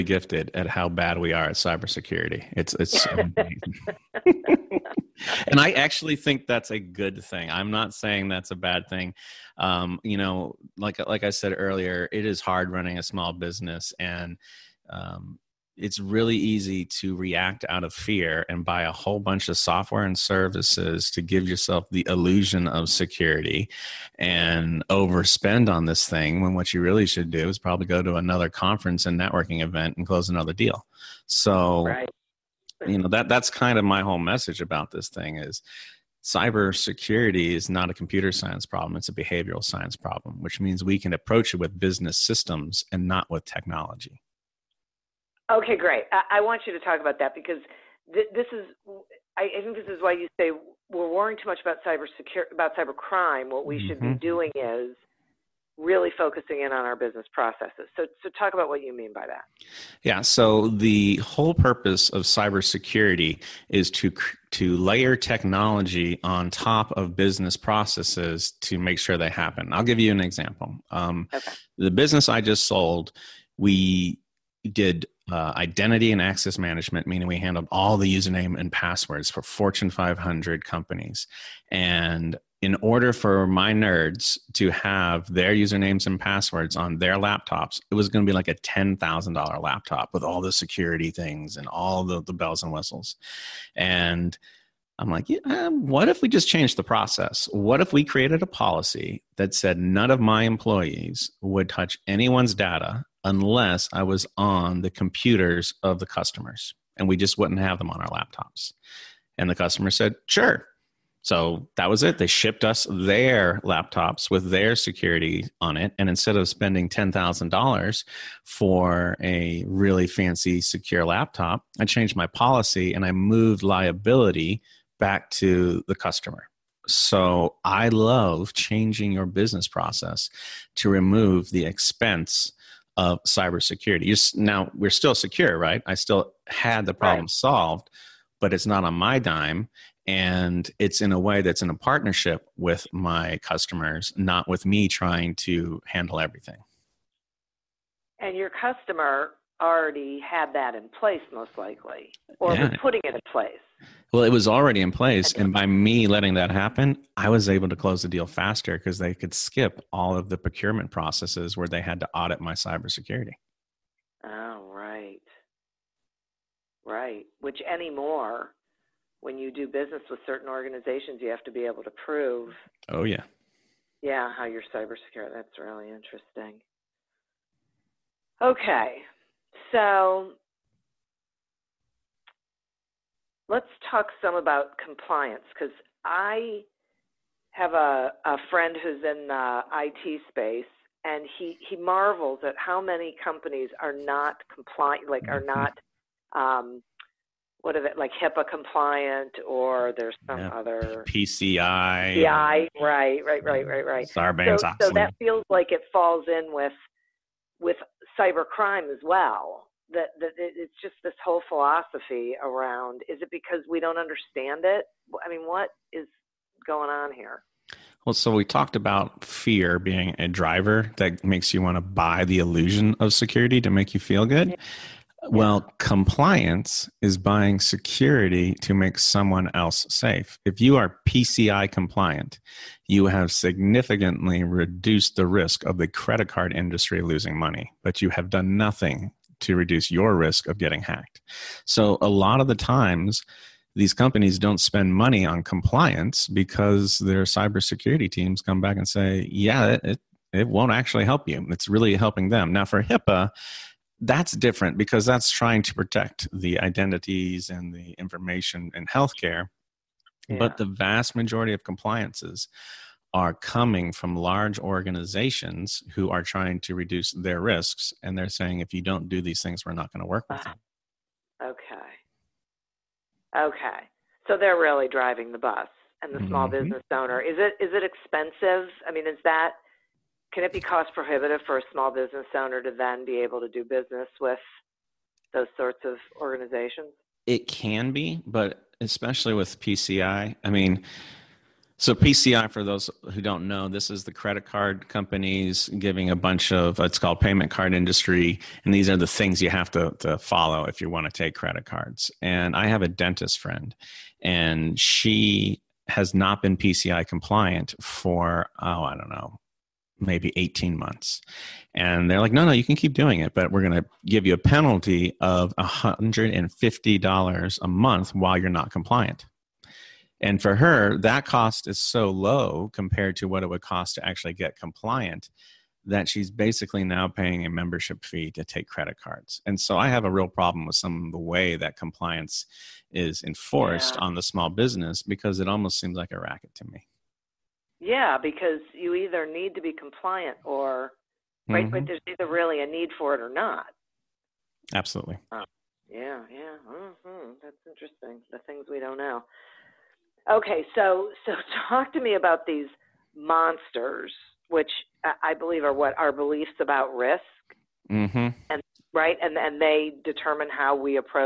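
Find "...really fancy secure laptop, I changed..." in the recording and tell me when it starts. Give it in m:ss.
1:59.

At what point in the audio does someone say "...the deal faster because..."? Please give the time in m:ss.
2:38.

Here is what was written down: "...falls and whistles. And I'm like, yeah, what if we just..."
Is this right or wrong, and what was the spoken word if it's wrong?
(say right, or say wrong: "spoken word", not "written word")
wrong: "bells", not "falls".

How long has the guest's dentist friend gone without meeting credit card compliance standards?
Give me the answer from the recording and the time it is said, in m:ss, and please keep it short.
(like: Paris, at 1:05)
18 months, at 5:10.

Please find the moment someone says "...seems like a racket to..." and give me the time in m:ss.
5:35.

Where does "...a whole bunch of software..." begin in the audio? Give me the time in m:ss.
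0:18.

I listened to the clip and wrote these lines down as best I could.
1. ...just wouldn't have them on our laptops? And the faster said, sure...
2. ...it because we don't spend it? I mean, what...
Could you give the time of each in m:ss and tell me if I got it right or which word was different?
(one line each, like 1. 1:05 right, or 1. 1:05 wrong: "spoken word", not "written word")
1. 1:47 wrong: "customer", not "faster"
2. 3:33 wrong: "understand", not "spend".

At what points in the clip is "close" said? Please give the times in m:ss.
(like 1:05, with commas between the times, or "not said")
0:30, 2:37.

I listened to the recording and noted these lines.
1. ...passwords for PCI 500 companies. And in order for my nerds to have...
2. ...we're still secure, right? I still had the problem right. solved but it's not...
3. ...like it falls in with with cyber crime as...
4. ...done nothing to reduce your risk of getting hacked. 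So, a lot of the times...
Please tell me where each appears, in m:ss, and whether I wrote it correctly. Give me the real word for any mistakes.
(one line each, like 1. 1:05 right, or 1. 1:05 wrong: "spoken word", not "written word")
1. 1:18 wrong: "Fortune", not "PCI"
2. 2:14 right
3. 3:25 right
4. 3:58 right.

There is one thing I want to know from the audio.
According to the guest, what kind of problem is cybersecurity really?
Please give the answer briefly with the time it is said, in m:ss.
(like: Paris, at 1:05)
behavioral science problem, at 0:39.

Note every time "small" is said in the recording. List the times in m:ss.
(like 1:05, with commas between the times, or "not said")
0:13, 4:36, 4:41, 5:34.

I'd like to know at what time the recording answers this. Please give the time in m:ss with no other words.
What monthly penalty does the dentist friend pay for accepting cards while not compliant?
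5:15.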